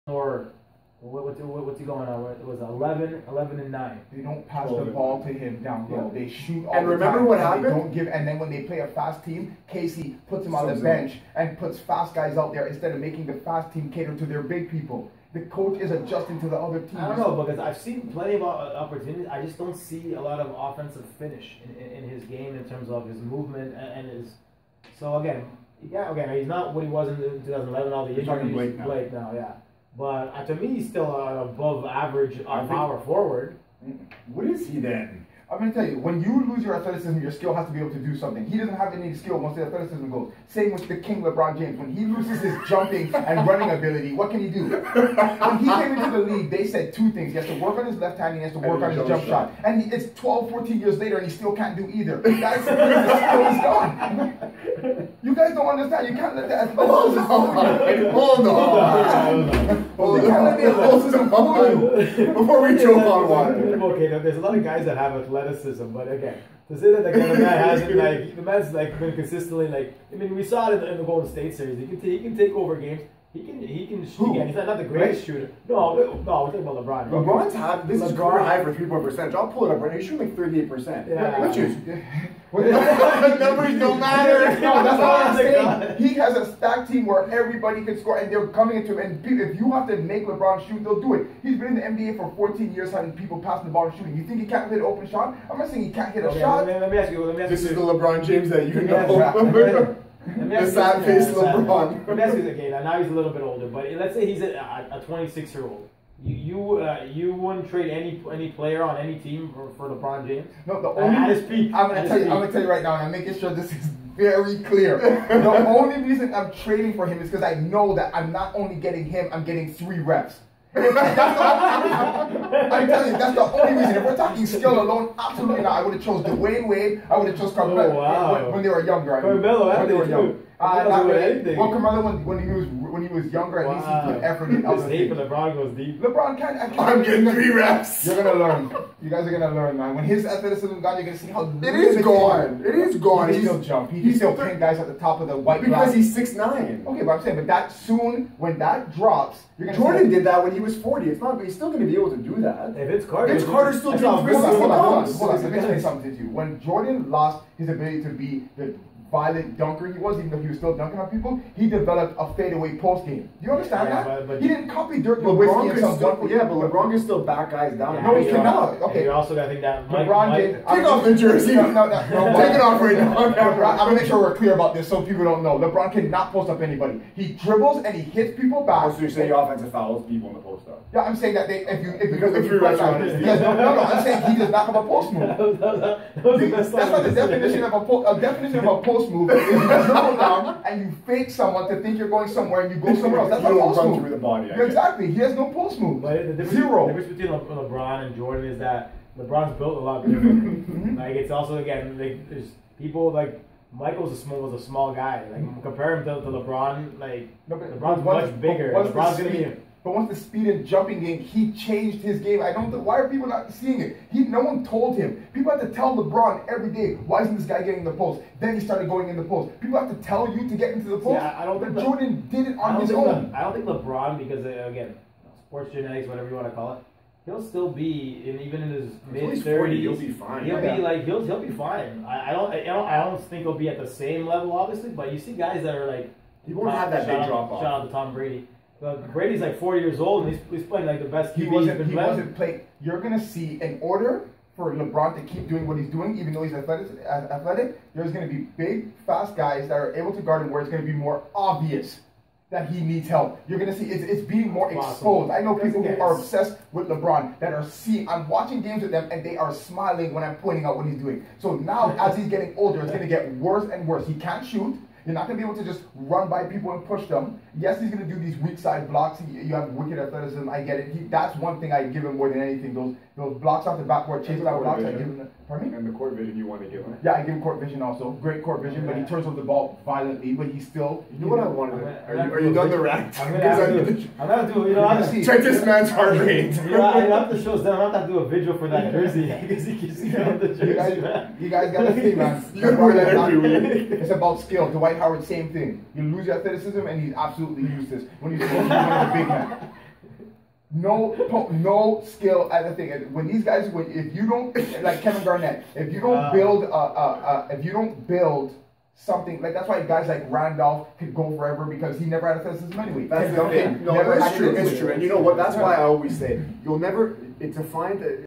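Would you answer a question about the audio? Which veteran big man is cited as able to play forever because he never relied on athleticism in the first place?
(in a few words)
Randolph.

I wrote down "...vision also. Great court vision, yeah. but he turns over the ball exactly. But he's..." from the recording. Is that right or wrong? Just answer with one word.
wrong.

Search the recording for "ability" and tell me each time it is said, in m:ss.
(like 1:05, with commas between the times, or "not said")
0:43, 2:37.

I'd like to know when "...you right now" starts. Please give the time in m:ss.
1:52.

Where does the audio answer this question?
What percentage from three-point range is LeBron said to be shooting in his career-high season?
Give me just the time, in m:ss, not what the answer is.
1:20.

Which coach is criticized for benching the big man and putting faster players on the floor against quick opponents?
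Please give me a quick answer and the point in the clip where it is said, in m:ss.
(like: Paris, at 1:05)
Casey, at 0:09.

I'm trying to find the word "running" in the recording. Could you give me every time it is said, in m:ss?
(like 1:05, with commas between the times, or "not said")
0:43.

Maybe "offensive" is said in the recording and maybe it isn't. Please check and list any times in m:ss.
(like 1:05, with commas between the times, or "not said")
0:20, 2:59.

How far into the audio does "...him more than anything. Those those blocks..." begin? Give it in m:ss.
4:32.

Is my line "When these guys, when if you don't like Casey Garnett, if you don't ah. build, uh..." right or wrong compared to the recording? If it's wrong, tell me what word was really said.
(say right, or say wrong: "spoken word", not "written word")
wrong: "Kevin", not "Casey".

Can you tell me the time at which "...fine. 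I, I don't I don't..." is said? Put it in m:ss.
3:51.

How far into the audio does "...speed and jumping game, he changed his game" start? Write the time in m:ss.
3:30.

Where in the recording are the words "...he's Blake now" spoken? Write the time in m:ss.
0:28.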